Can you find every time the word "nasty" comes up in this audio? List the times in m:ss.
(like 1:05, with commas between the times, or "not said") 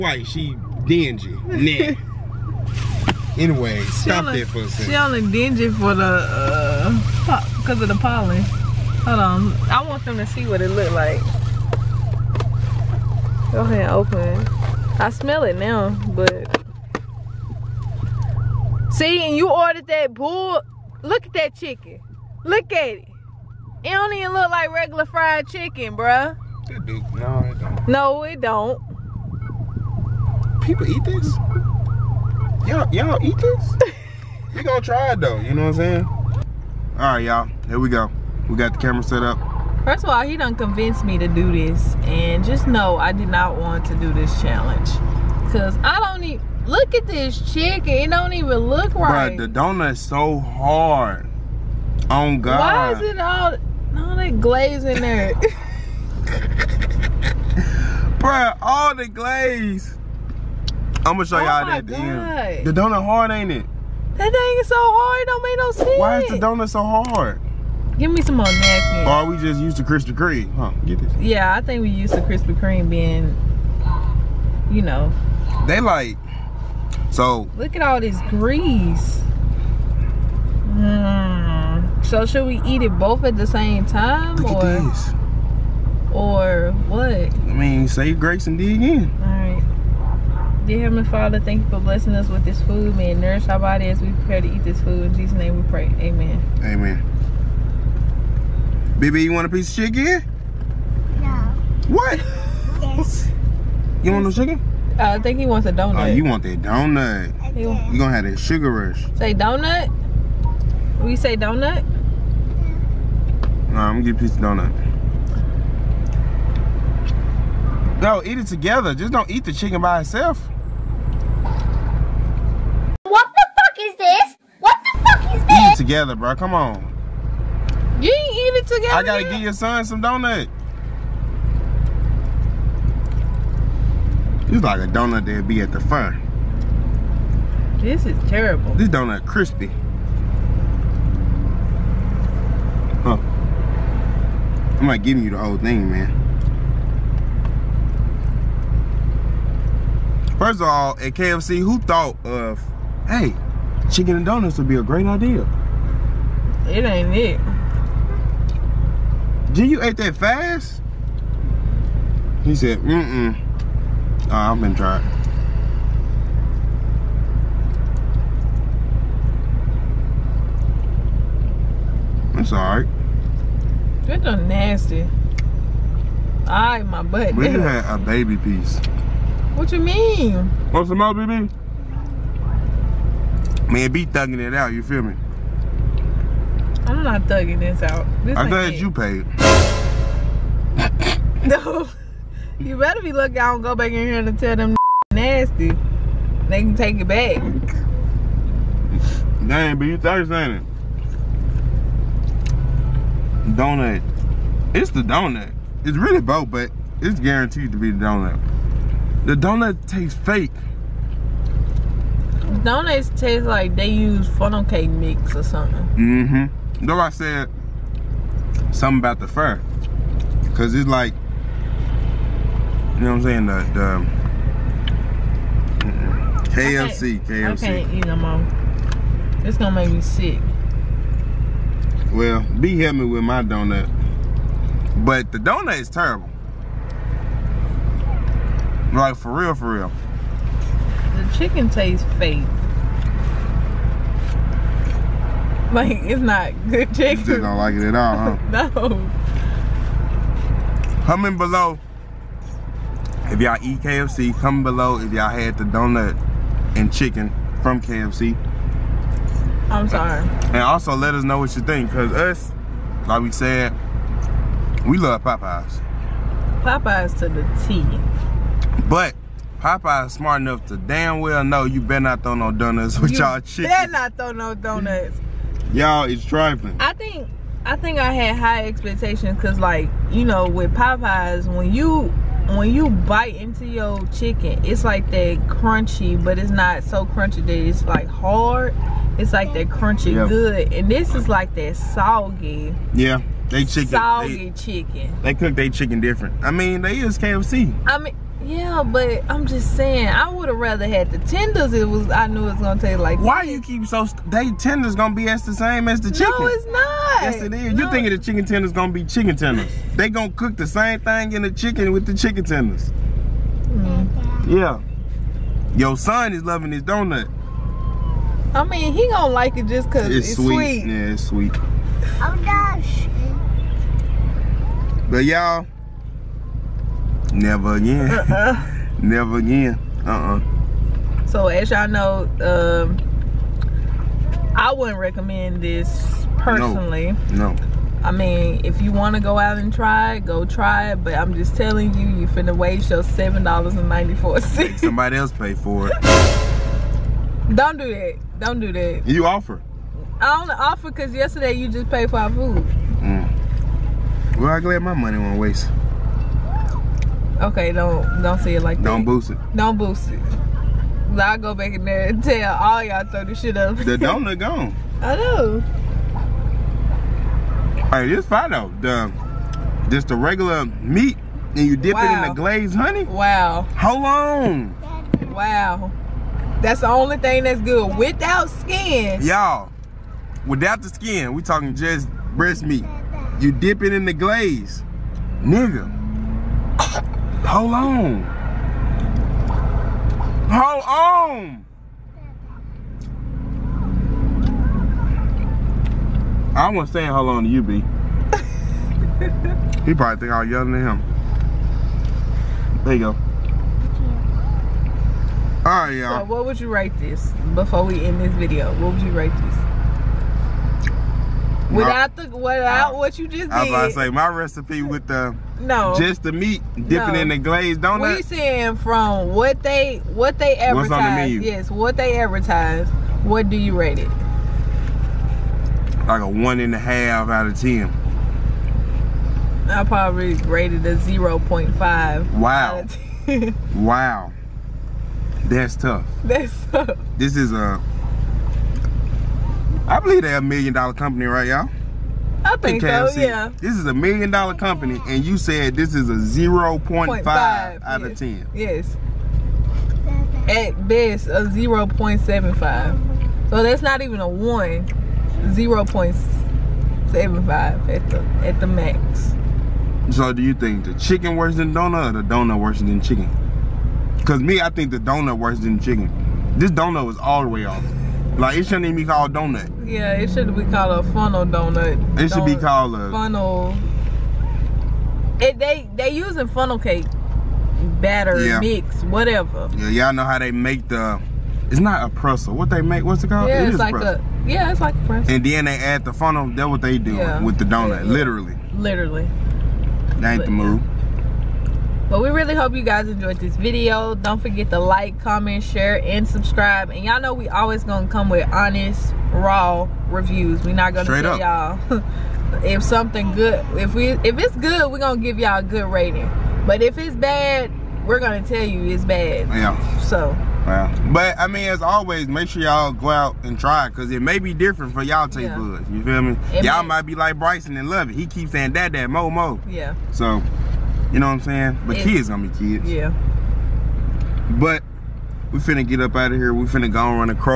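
2:54, 3:15.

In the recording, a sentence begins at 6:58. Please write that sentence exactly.
We saying from what they what they advertise.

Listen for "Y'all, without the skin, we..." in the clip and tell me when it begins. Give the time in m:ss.
6:19.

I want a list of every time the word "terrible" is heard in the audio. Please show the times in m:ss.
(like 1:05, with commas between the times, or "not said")
2:18, 3:55.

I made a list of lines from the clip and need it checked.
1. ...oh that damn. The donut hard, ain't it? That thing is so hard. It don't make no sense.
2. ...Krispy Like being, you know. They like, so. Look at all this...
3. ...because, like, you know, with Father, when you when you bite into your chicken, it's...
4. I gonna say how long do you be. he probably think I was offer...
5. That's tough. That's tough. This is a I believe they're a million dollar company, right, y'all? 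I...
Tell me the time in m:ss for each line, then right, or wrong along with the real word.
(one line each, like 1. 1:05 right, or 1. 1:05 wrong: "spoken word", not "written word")
1. 1:01 right
2. 1:12 wrong: "Kreme", not "Like"
3. 4:39 wrong: "Popeyes", not "Father"
4. 6:36 wrong: "younger", not "offer"
5. 7:15 right.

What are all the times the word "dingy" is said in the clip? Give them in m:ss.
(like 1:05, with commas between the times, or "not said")
0:00, 0:05.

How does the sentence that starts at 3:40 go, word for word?
Cause it's like, you know what I'm saying?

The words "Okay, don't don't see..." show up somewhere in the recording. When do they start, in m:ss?
5:57.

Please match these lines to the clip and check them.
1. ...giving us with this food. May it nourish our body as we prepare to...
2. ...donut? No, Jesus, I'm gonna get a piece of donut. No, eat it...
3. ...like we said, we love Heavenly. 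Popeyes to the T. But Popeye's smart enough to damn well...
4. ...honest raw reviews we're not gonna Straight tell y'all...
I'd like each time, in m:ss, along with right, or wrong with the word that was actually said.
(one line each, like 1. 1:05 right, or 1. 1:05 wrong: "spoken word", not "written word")
1. 1:31 wrong: "blessing", not "giving"
2. 1:51 wrong: "Nah", not "Jesus"
3. 4:23 wrong: "Popeyes", not "Heavenly"
4. 8:18 right.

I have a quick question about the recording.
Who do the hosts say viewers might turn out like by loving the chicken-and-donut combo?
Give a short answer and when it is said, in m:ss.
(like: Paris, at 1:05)
Bryson, at 8:37.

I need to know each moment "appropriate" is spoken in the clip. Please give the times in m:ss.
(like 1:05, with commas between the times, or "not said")
not said.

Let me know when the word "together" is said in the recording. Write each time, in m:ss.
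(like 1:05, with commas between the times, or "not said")
1:58, 2:05.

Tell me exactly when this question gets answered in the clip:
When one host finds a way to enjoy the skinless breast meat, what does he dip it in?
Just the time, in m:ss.
6:12.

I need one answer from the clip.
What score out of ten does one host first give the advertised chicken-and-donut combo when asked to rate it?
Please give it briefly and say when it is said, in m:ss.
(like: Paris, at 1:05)
1.5, at 7:06.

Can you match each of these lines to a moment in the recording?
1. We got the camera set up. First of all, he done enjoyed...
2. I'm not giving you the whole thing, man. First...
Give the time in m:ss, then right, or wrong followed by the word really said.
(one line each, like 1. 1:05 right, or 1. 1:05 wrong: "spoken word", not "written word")
1. 0:38 wrong: "convinced", not "enjoyed"
2. 2:24 right.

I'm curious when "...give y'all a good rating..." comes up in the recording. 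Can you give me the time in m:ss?
8:25.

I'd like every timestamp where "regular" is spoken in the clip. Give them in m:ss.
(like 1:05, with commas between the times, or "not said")
0:24, 6:10.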